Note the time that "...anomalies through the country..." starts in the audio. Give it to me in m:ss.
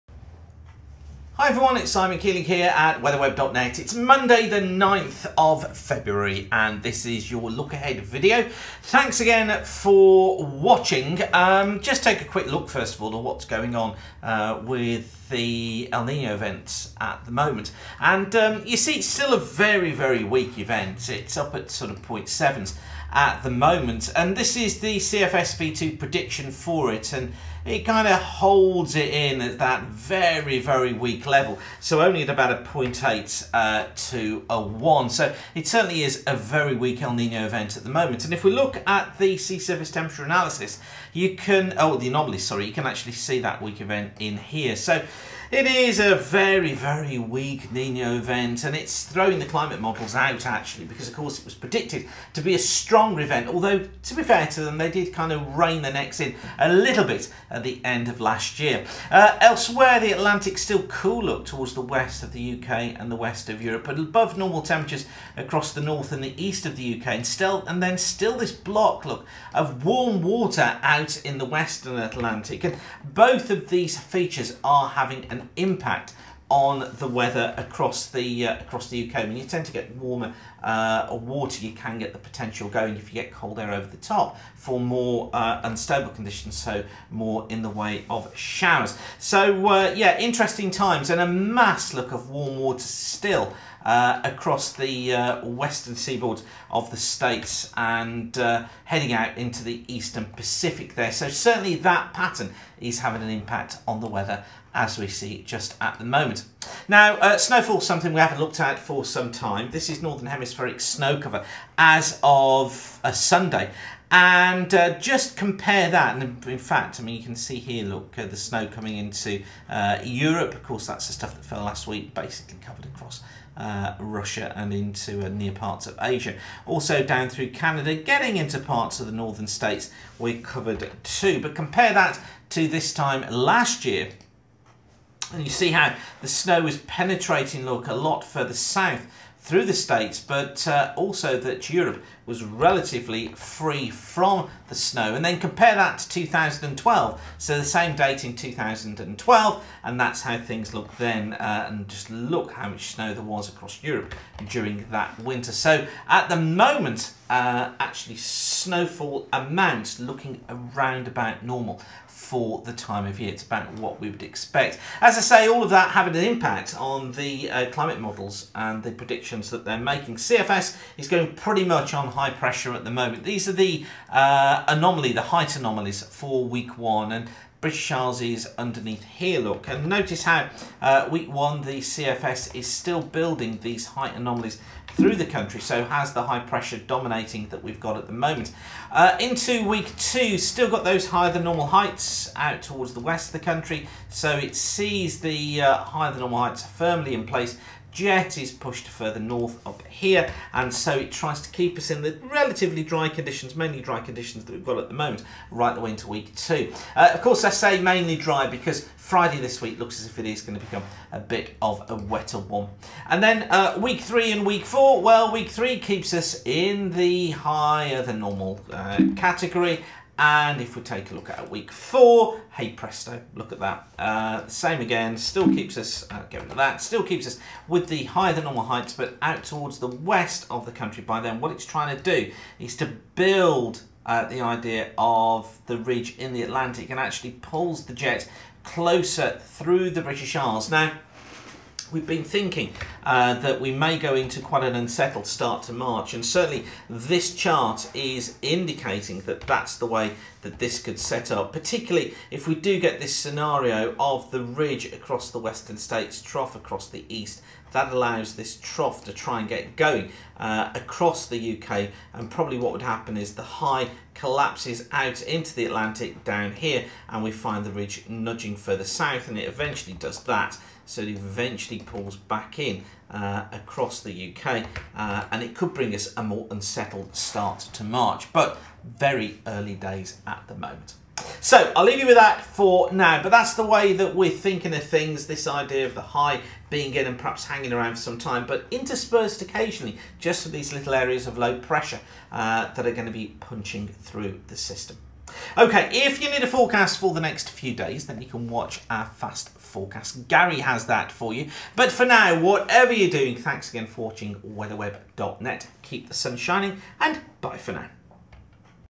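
3:04.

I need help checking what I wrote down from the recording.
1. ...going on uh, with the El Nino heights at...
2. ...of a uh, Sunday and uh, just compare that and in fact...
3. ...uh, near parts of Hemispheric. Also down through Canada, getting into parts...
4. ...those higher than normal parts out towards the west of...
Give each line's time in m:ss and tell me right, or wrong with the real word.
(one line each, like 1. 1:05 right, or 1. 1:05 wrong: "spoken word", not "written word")
1. 0:13 wrong: "events", not "heights"
2. 1:52 right
3. 2:05 wrong: "Asia", not "Hemispheric"
4. 3:10 wrong: "heights", not "parts".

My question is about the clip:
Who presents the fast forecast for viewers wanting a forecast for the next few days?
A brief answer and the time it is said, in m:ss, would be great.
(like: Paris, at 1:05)
Gary, at 5:00.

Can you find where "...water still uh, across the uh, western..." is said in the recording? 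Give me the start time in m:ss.
1:32.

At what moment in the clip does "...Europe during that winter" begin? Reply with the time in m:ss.
2:33.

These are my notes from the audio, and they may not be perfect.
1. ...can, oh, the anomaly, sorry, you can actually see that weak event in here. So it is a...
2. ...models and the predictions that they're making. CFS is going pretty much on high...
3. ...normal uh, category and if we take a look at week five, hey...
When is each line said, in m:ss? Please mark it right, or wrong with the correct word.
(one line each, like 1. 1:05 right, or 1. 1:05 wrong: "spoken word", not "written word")
1. 0:41 right
2. 2:48 right
3. 3:38 wrong: "four", not "five".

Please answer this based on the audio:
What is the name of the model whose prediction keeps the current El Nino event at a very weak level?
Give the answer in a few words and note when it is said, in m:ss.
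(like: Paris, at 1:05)
CFSv2, at 0:24.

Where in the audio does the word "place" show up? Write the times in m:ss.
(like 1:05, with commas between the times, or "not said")
3:17.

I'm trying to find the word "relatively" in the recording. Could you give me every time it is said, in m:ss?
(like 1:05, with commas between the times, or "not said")
2:22, 3:22.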